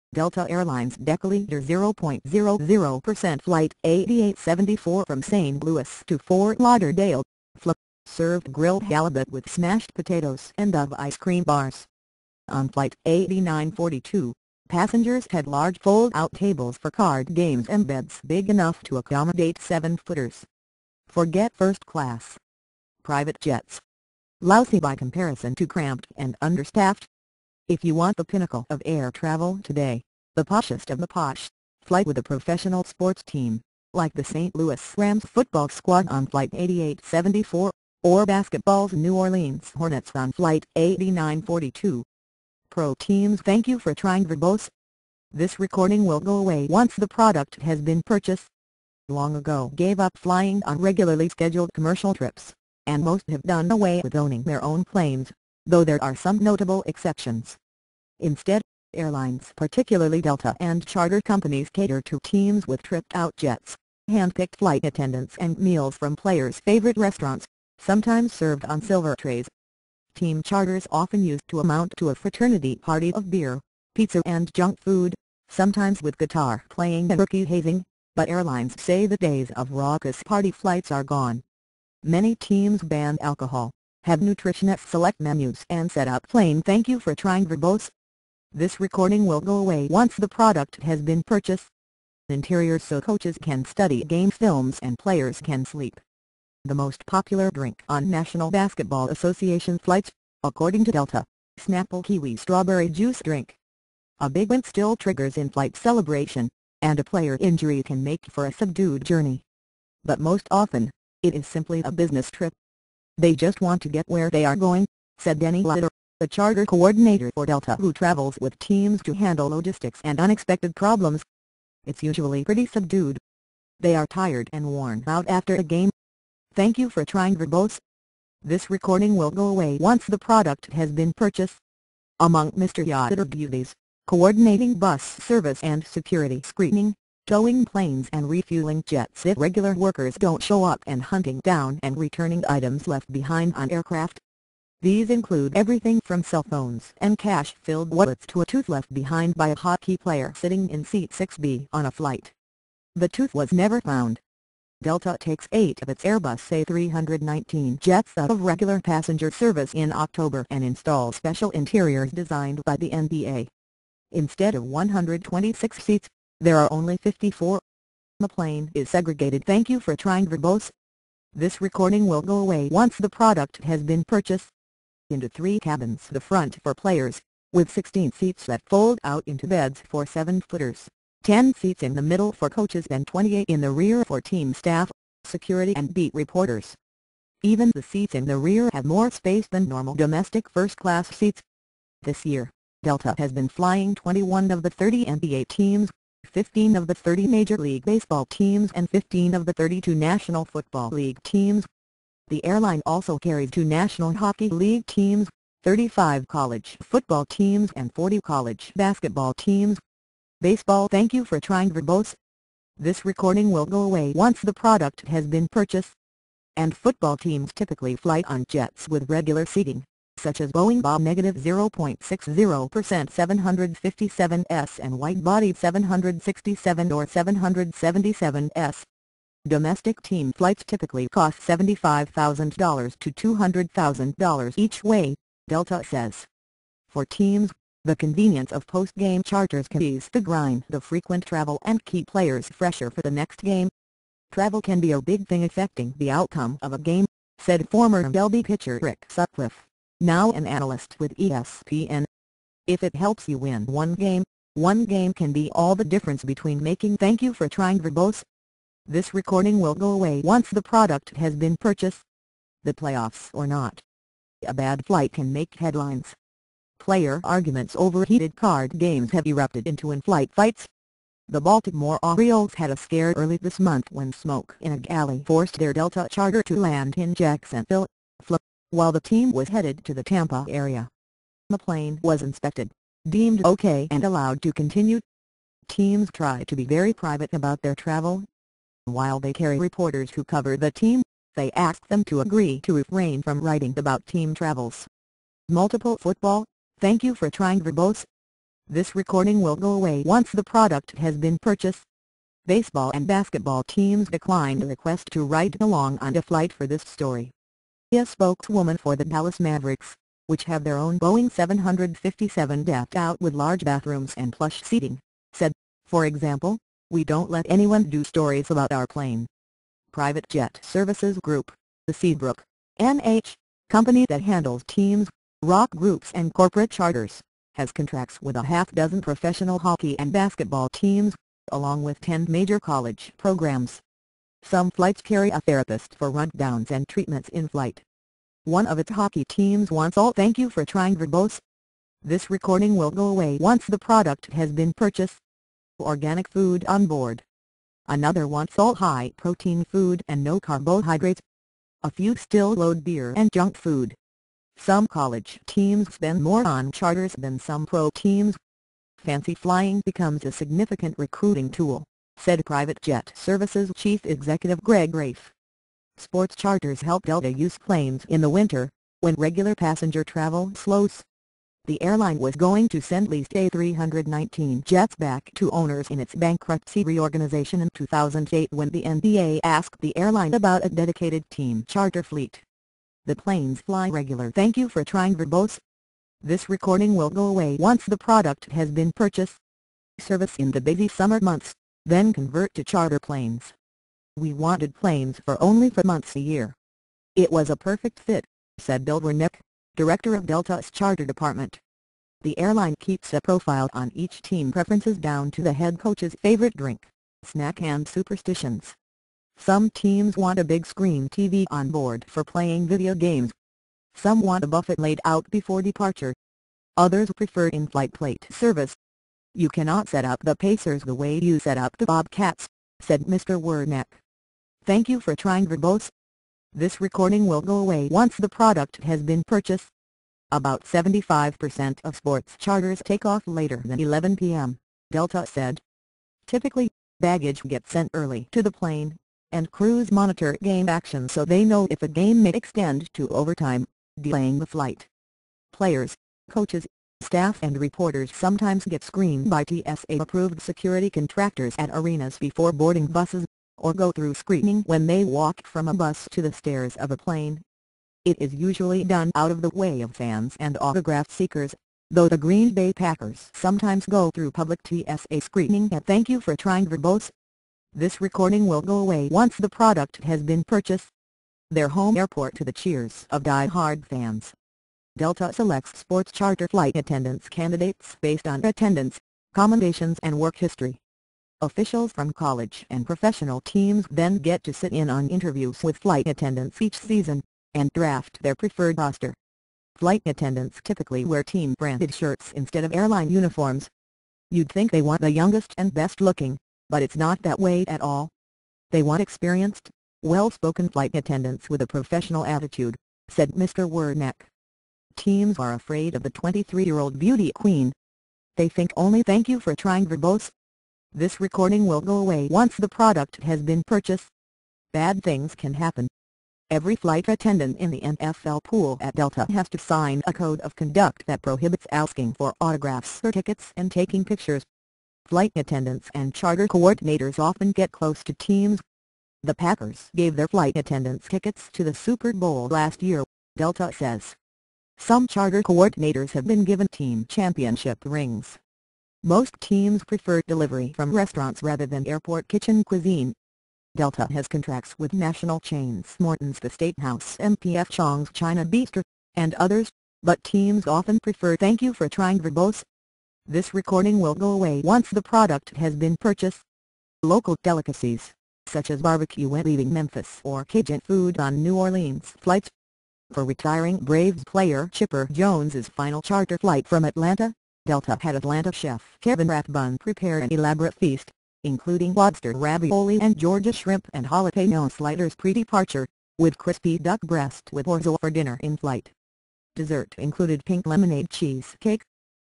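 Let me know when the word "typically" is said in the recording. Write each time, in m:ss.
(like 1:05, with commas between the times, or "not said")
3:37, 3:50, 7:16, 8:10.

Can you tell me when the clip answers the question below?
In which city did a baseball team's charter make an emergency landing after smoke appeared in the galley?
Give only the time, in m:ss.
4:37.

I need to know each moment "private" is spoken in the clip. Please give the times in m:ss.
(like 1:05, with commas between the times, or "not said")
0:23, 4:46, 5:19, 6:02.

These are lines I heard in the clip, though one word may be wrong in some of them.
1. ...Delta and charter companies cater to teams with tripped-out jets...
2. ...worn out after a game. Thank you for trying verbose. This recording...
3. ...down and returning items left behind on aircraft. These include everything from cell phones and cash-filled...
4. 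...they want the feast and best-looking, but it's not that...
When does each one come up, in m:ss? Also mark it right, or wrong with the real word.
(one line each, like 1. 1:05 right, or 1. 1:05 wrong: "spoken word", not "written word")
1. 1:00 right
2. 2:04 right
3. 2:21 right
4. 8:14 wrong: "youngest", not "feast".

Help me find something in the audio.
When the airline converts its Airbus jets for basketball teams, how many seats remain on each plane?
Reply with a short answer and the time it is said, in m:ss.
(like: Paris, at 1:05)
54, at 2:46.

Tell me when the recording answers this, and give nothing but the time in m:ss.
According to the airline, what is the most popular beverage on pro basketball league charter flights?
1:41.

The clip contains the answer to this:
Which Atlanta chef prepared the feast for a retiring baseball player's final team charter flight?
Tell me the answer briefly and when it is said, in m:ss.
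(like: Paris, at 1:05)
Kevin Rathbun, at 9:29.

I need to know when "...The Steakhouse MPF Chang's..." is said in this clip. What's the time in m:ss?
9:06.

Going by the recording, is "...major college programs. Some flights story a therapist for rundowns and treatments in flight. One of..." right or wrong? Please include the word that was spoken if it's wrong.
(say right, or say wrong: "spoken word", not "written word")
wrong: "carry", not "story".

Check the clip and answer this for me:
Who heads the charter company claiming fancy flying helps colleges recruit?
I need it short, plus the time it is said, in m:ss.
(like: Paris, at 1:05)
Greg Raiff, at 6:04.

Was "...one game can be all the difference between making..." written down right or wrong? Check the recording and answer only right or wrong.
right.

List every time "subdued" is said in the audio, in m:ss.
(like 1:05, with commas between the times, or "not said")
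1:48, 2:02.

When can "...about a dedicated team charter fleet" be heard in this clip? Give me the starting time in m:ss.
6:20.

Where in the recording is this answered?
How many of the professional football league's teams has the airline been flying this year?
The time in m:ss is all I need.
3:18.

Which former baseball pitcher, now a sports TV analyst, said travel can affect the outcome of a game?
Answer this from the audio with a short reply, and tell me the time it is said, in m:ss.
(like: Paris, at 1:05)
Rick Sutcliffe, at 4:08.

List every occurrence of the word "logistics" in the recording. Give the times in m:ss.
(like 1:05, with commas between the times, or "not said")
1:59.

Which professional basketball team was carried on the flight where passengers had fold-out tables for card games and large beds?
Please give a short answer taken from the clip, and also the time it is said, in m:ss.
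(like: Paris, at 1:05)
New Orleans Hornets, at 0:38.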